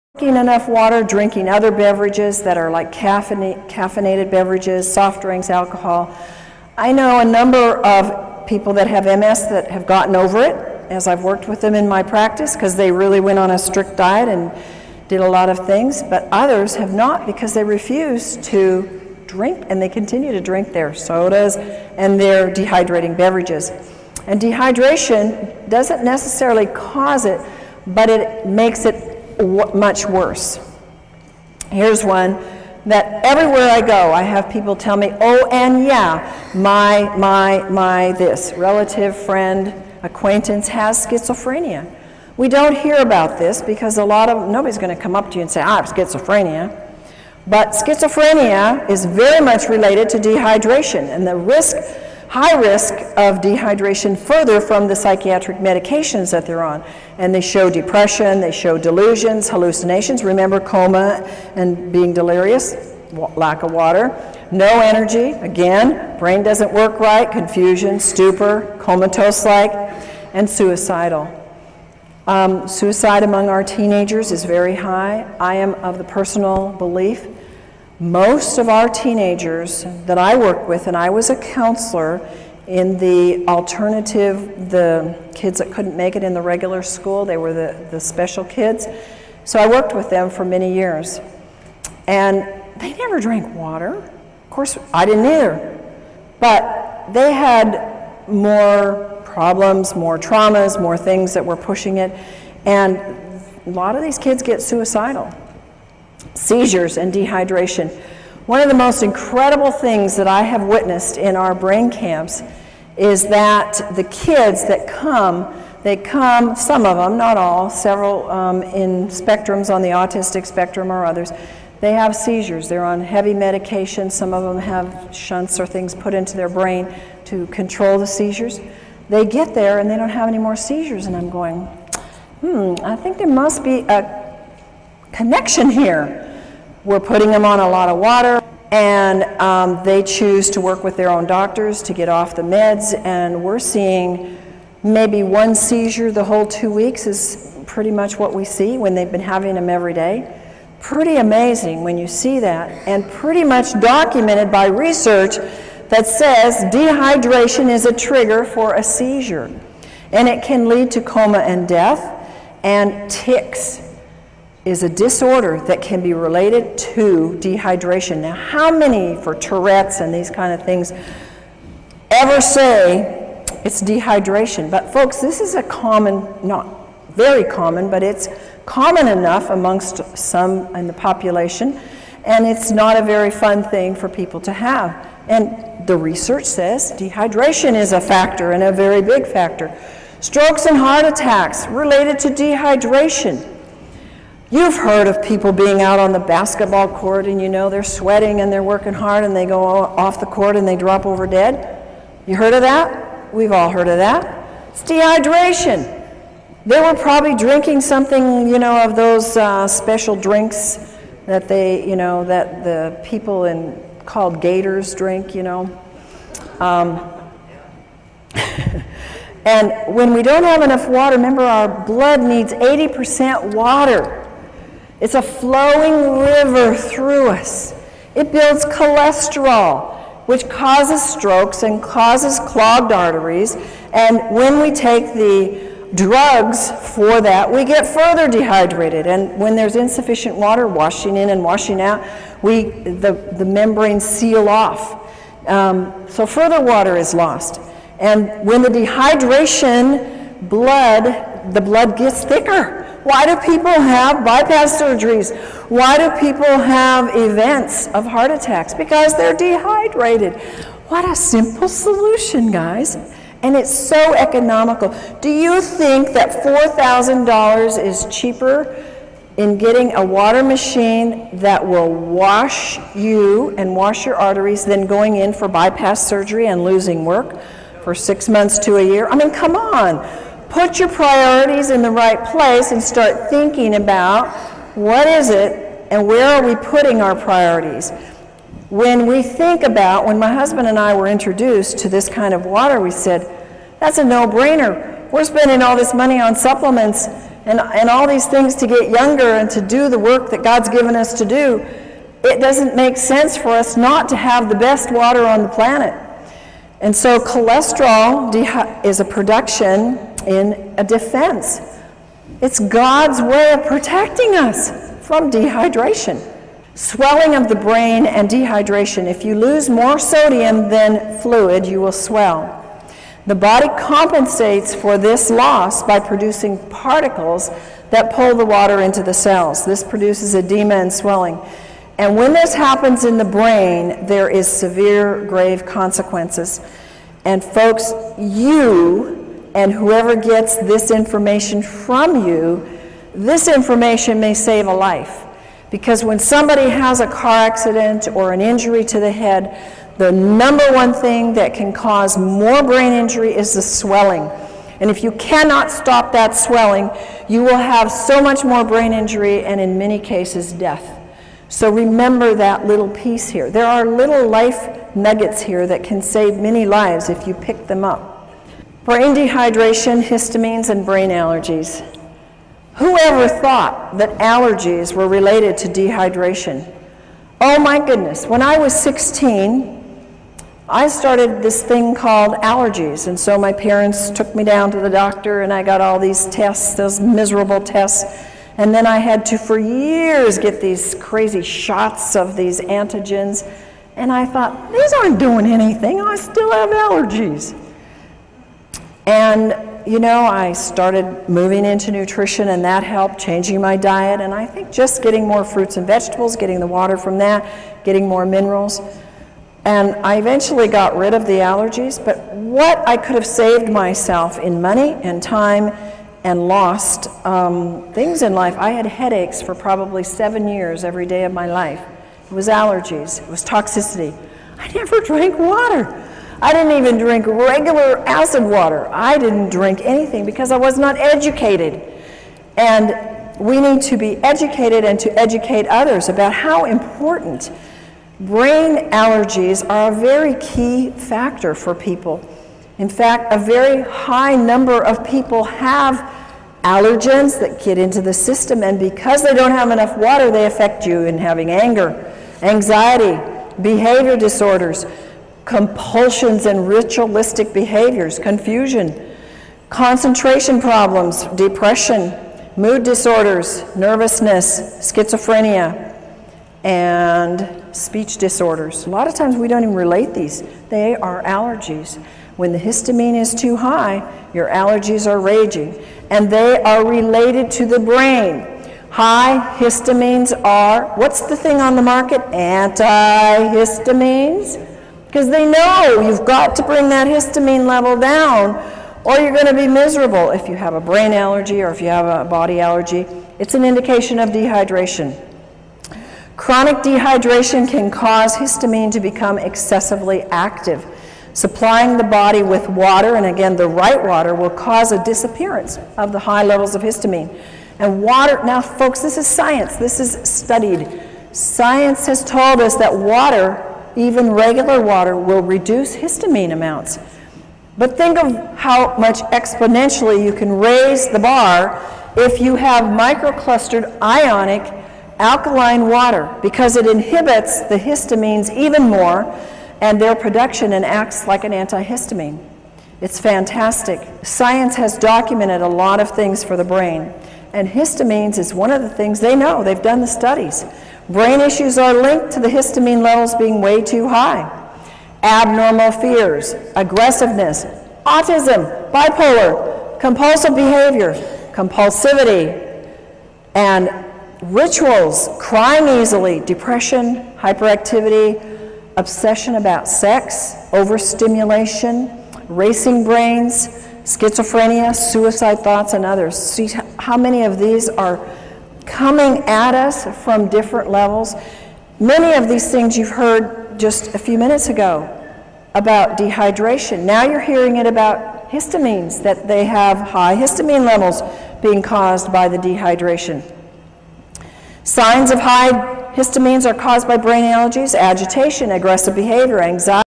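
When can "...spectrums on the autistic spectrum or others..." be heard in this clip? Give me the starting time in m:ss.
1:59.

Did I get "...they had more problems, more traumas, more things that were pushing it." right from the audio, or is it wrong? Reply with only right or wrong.
right.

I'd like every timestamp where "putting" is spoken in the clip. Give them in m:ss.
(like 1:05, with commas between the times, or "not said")
2:16, 4:46.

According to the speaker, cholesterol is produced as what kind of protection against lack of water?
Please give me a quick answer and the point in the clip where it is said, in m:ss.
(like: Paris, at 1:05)
defense, at 5:10.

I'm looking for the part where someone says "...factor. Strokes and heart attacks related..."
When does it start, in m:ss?
3:09.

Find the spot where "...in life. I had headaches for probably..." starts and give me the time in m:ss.
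6:58.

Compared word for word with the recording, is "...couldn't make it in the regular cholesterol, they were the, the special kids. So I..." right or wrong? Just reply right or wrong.
wrong.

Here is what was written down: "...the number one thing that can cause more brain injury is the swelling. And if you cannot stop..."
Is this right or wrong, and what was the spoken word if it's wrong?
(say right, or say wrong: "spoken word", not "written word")
right.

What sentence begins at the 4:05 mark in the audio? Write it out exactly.
Um, so further water is lost.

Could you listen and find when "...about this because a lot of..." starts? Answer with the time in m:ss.
0:42.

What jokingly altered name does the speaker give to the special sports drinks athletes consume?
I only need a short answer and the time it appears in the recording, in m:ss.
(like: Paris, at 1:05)
Gators, at 3:34.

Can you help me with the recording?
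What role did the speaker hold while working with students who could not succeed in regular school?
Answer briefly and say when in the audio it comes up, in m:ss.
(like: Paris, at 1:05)
counselor, at 1:21.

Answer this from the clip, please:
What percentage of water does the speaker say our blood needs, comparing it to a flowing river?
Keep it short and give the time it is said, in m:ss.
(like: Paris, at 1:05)
80%, at 3:42.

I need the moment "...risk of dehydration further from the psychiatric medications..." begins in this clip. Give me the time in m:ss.
0:52.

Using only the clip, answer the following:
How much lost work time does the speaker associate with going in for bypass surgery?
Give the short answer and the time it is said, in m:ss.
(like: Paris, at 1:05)
six months to a year, at 4:37.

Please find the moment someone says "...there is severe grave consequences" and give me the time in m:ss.
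5:34.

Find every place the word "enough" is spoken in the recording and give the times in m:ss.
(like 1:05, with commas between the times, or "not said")
0:00, 2:59, 3:40, 7:29.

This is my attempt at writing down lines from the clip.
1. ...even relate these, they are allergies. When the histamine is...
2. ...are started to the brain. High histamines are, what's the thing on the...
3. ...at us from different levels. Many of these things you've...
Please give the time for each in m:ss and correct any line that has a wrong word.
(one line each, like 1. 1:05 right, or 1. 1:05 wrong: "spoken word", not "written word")
1. 7:49 right
2. 7:56 wrong: "related", not "started"
3. 9:29 right.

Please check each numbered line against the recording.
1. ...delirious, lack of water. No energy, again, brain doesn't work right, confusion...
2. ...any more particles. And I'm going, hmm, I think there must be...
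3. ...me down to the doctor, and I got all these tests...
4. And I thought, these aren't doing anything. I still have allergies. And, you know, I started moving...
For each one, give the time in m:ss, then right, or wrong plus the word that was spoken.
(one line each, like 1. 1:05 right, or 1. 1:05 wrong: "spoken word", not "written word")
1. 1:02 right
2. 2:10 wrong: "seizures", not "particles"
3. 6:24 right
4. 6:33 right.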